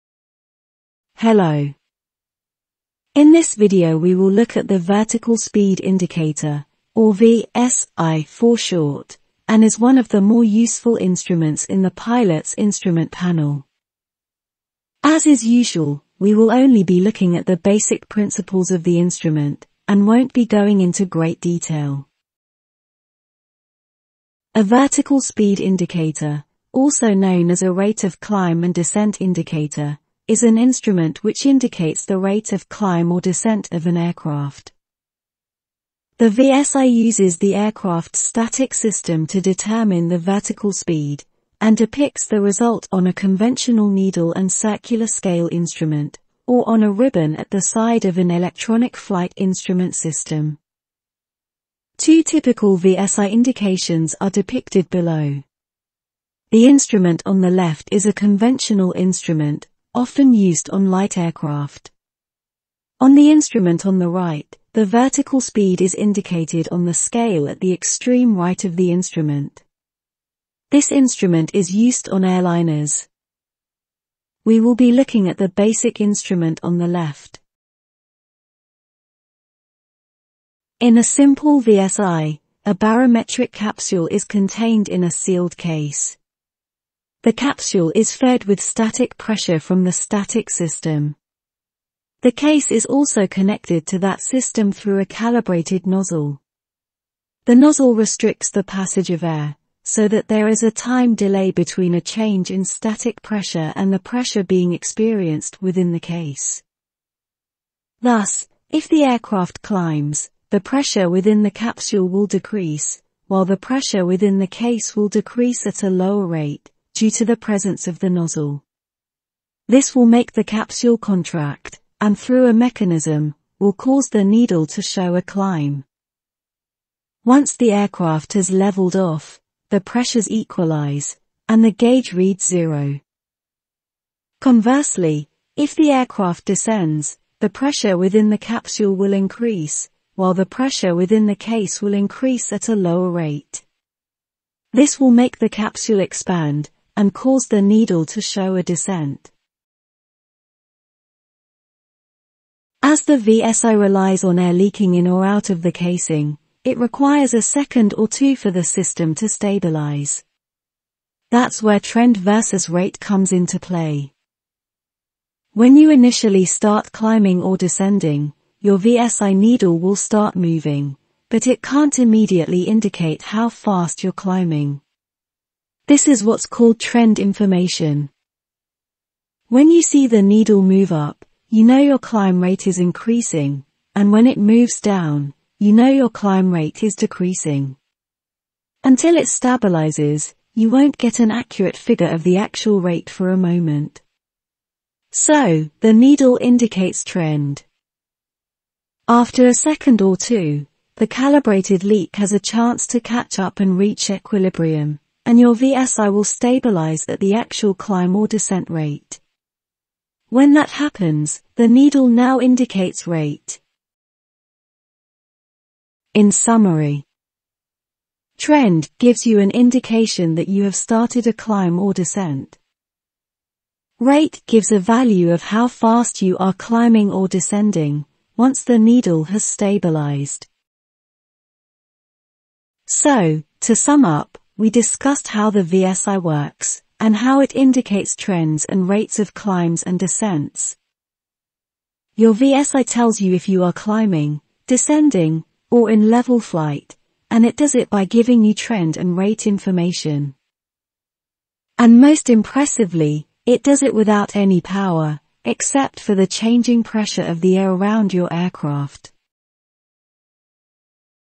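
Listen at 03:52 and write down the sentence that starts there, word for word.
So, to sum up, we discussed how the VSI works, and how it indicates trends and rates of climbs and descents.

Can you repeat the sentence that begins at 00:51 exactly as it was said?
Two typical VSI indications are depicted below.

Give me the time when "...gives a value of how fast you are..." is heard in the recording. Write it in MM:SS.
03:44.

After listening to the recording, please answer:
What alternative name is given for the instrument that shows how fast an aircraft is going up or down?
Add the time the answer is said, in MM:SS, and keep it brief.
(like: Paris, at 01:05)
rate of climb and descent indicator, at 00:27.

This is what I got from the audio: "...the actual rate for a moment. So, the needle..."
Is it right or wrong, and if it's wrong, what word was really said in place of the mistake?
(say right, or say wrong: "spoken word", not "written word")
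right.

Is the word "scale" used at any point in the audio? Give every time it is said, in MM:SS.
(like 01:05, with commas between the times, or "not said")
00:45, 01:06.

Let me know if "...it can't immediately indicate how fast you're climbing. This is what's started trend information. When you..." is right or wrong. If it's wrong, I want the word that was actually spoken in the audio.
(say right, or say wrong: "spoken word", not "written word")
wrong: "called", not "started".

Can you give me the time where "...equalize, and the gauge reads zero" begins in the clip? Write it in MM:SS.
02:10.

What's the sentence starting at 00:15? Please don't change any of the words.
As is usual, we will only be looking at the basic principles of the instrument, and won't be going into great detail.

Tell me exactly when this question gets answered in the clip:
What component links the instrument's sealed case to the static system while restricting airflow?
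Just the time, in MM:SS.
01:35.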